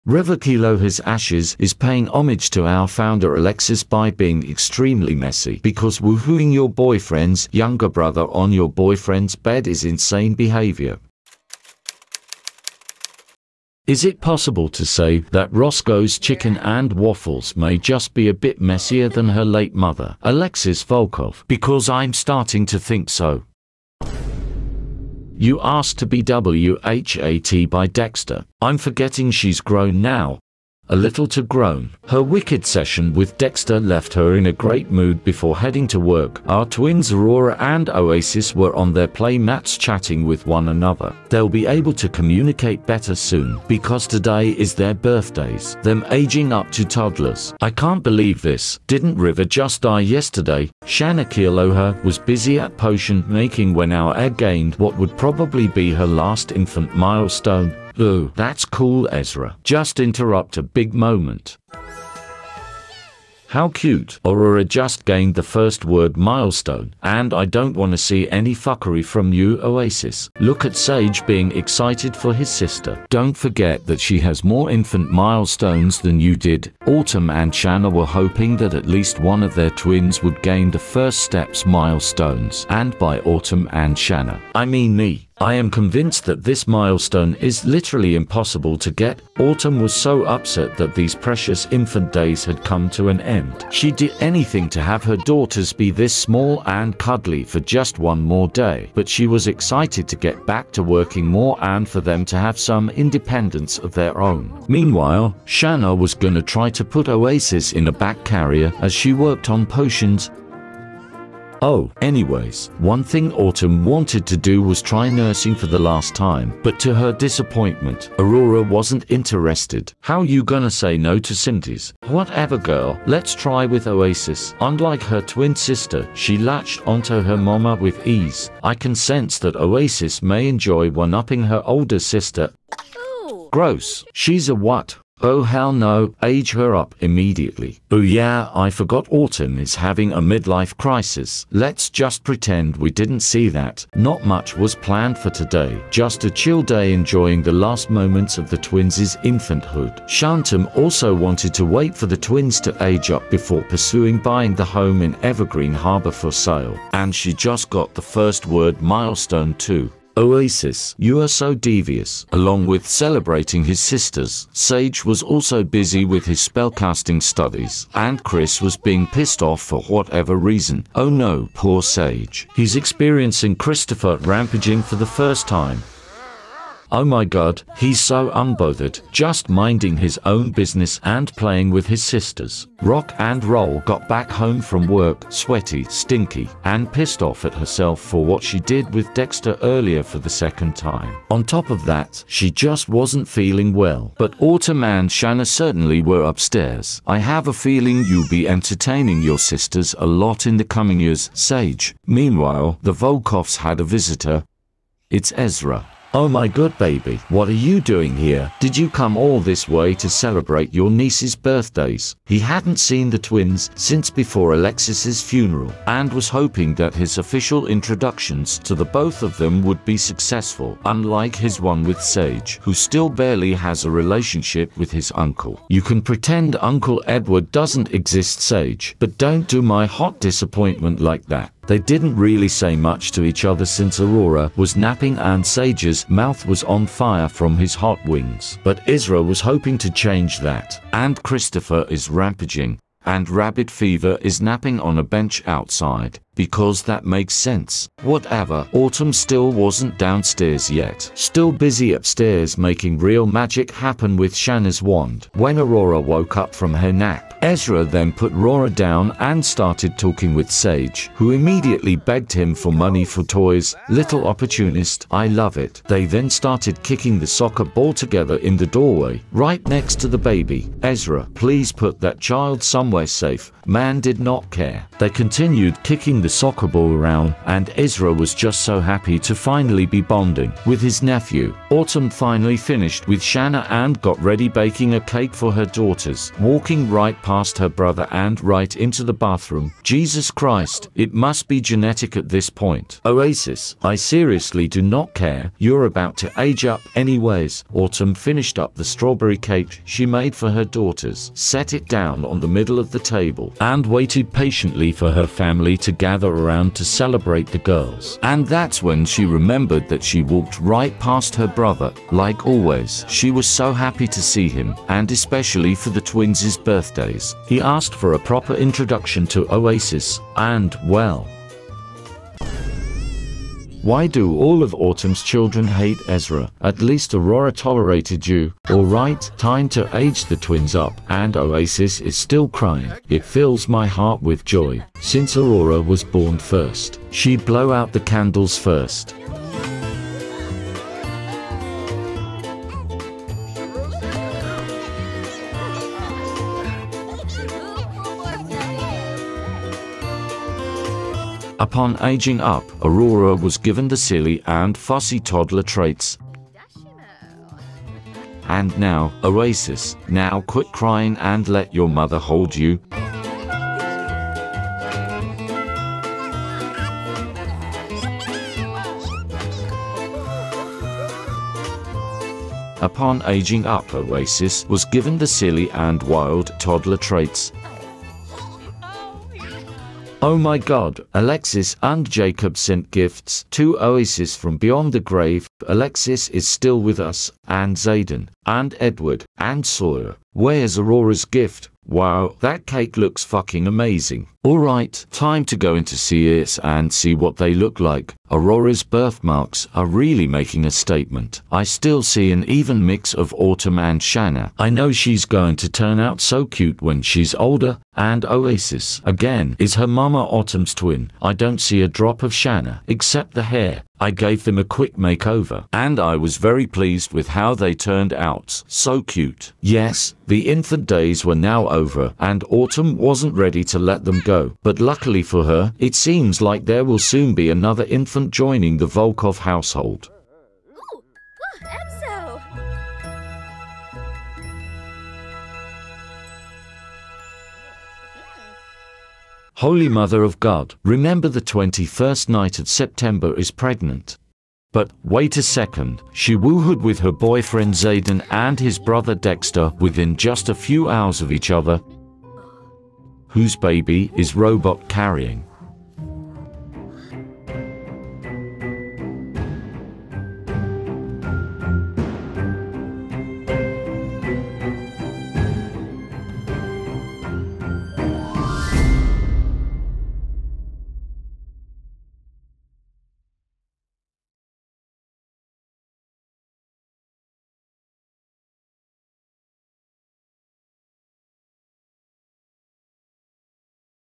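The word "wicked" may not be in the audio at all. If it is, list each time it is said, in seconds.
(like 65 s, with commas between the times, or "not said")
32 s.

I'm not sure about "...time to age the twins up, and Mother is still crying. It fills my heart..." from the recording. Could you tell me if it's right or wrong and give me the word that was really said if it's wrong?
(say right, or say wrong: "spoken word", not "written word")
wrong: "Oasis", not "Mother".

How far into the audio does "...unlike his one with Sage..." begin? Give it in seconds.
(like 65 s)
220 s.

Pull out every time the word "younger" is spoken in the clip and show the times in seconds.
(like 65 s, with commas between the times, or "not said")
7 s.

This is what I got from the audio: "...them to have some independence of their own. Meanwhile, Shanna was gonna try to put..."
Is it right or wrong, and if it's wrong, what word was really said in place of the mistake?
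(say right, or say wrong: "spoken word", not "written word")
right.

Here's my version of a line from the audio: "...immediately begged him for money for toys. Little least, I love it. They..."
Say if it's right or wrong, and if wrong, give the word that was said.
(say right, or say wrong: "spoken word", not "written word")
wrong: "opportunist", not "least".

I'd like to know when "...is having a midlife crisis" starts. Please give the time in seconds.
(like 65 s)
139 s.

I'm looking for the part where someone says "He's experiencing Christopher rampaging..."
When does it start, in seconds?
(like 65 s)
172 s.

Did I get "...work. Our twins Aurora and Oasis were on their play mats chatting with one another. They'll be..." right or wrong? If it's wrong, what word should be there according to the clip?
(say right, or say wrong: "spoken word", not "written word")
right.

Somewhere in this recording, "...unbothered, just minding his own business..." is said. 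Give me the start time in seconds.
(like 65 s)
178 s.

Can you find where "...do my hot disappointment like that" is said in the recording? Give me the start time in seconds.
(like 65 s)
229 s.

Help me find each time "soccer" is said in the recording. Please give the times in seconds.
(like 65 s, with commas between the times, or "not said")
267 s, 276 s.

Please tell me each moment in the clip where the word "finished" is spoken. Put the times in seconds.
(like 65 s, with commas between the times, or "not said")
282 s, 298 s.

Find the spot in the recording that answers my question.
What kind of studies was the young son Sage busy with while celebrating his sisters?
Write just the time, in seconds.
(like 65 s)
166 s.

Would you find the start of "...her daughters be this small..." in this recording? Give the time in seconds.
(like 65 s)
95 s.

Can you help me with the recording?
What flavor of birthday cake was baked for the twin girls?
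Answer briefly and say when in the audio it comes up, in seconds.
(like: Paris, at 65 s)
Strawberry, at 298 s.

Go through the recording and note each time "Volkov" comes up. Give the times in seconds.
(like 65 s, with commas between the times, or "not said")
20 s, 202 s, 428 s.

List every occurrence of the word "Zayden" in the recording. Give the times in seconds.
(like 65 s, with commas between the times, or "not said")
387 s, 447 s.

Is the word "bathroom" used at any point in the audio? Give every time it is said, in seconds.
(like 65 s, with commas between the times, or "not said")
289 s.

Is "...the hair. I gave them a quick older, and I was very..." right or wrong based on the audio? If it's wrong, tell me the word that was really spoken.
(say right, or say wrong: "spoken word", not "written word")
wrong: "makeover", not "older".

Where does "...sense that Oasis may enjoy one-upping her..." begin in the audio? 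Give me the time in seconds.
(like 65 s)
128 s.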